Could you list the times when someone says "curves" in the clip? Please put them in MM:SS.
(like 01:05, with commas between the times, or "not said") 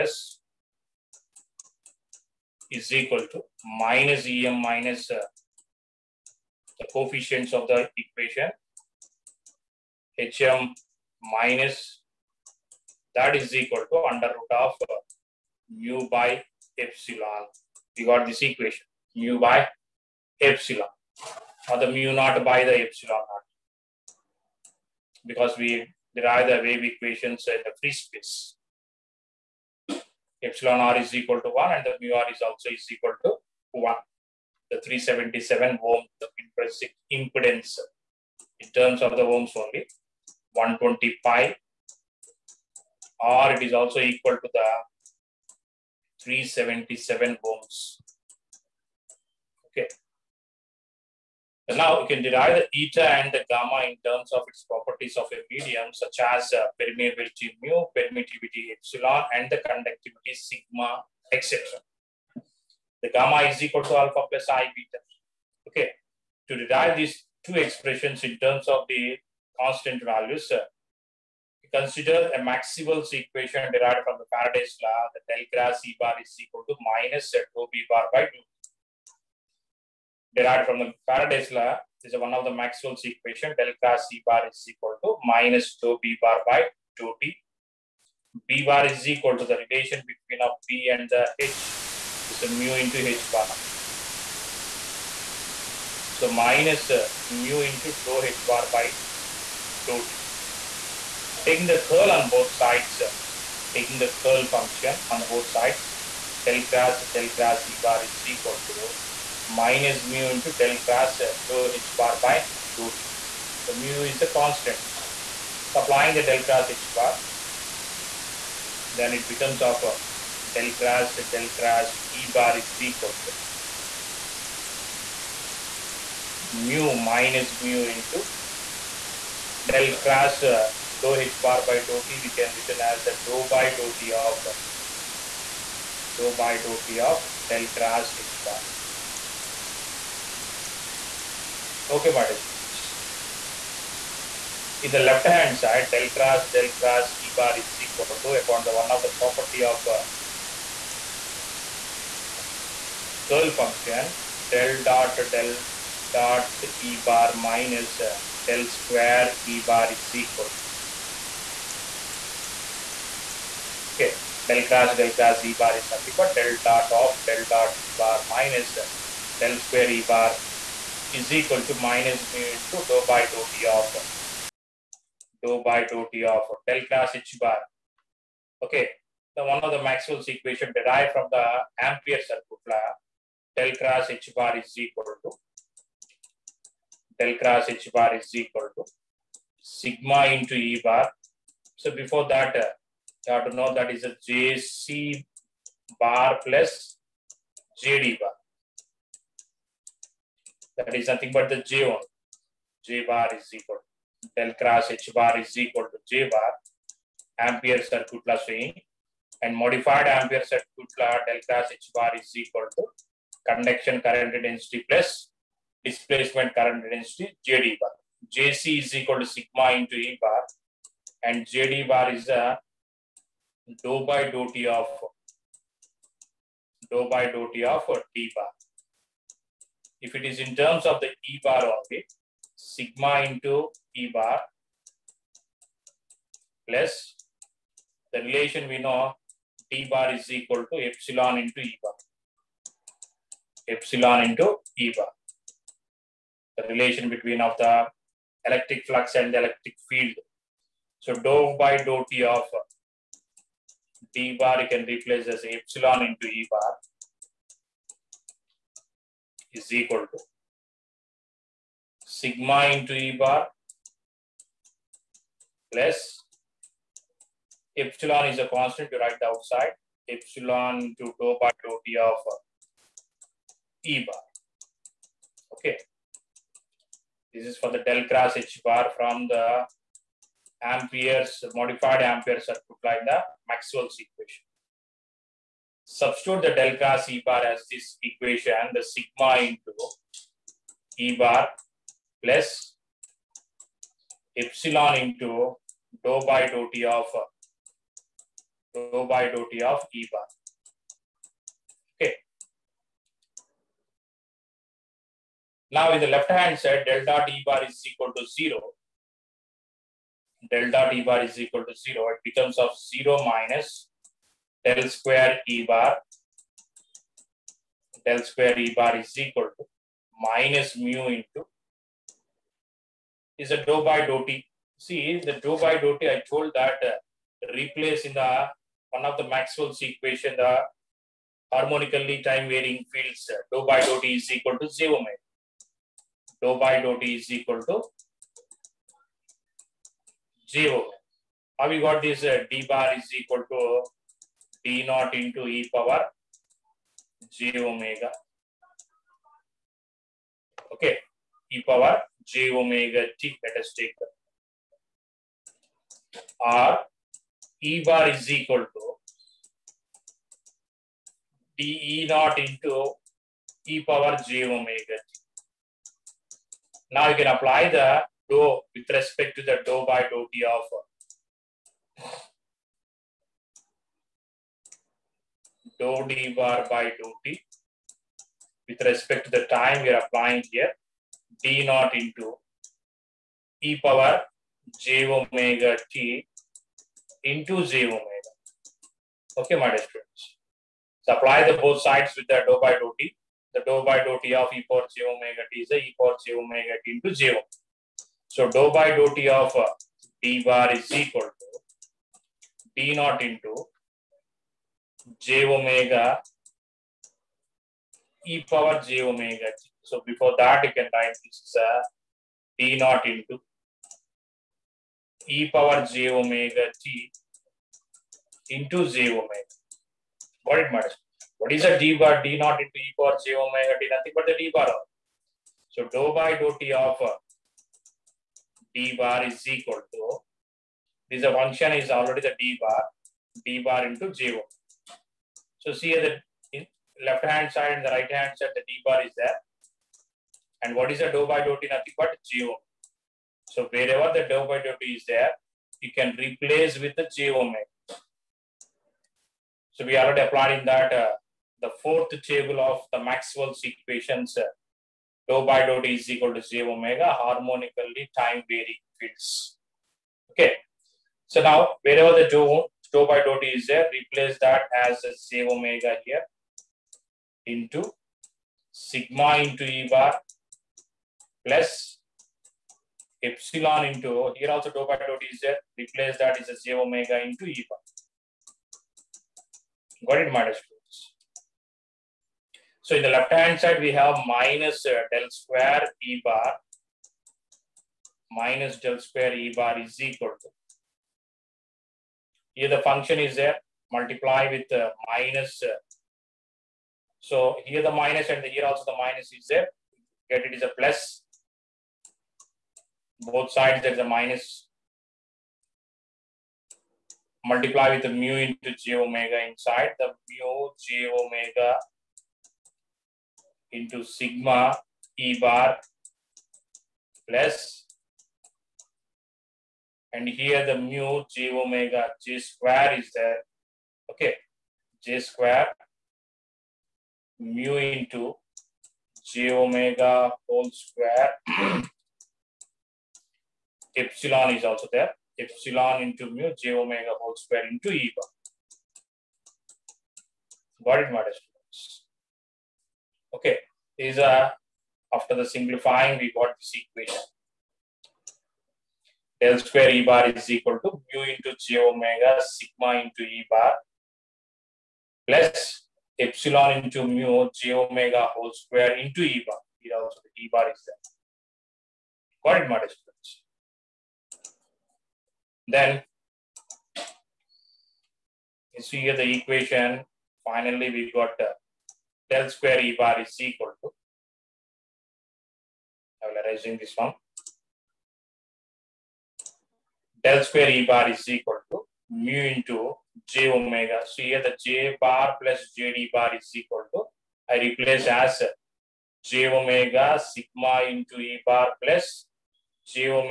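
not said.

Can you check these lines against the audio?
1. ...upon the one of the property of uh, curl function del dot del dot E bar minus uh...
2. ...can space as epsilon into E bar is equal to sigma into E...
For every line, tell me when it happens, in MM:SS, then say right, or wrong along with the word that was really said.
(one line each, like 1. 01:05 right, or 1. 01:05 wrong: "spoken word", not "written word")
1. 02:28 right
2. 04:14 wrong: "replace", not "space".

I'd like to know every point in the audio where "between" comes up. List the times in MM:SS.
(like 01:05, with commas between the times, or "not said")
01:30, 04:07.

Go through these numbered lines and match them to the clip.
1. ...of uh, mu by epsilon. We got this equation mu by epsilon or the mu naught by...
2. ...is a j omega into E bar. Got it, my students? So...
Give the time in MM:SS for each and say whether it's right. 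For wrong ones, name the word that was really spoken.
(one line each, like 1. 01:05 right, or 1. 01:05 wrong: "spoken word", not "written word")
1. 00:14 right
2. 07:56 right.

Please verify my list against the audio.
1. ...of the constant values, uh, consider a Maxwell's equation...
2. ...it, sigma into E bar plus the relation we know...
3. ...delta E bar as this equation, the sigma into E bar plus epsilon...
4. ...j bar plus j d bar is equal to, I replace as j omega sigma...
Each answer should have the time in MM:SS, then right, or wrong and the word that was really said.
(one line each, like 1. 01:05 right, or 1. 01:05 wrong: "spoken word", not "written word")
1. 01:08 right
2. 03:51 right
3. 04:46 right
4. 09:44 right.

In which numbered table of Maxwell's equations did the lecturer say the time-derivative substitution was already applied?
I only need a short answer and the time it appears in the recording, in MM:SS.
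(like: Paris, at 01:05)
fourth table, at 07:31.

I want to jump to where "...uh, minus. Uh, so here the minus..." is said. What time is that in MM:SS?
08:14.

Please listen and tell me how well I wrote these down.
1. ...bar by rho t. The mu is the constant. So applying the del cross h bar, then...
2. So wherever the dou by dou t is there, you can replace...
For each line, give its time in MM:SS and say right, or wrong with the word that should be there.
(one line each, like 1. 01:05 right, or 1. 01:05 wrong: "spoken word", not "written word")
1. 01:51 right
2. 07:23 right.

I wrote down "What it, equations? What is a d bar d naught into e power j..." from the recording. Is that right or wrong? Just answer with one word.
wrong.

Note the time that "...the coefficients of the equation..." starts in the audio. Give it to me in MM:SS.
00:06.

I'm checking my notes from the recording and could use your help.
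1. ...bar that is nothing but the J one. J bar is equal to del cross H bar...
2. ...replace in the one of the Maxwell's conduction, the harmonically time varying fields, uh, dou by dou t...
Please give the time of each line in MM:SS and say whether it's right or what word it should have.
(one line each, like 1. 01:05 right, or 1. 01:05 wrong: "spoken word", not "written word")
1. 03:18 right
2. 05:27 wrong: "equation", not "conduction".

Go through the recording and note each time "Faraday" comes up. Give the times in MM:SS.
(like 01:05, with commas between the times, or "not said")
01:14, 01:21.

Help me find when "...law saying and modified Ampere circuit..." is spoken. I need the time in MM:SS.
03:28.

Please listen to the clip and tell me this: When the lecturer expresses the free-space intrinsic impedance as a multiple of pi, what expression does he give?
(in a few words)
120 pi.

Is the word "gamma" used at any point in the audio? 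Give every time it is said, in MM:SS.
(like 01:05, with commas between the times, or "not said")
00:53, 01:03.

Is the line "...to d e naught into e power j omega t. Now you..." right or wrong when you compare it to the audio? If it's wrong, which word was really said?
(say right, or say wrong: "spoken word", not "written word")
right.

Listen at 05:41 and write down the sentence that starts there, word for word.
Have we got this uh, d bar is equal to p naught into e power j omega.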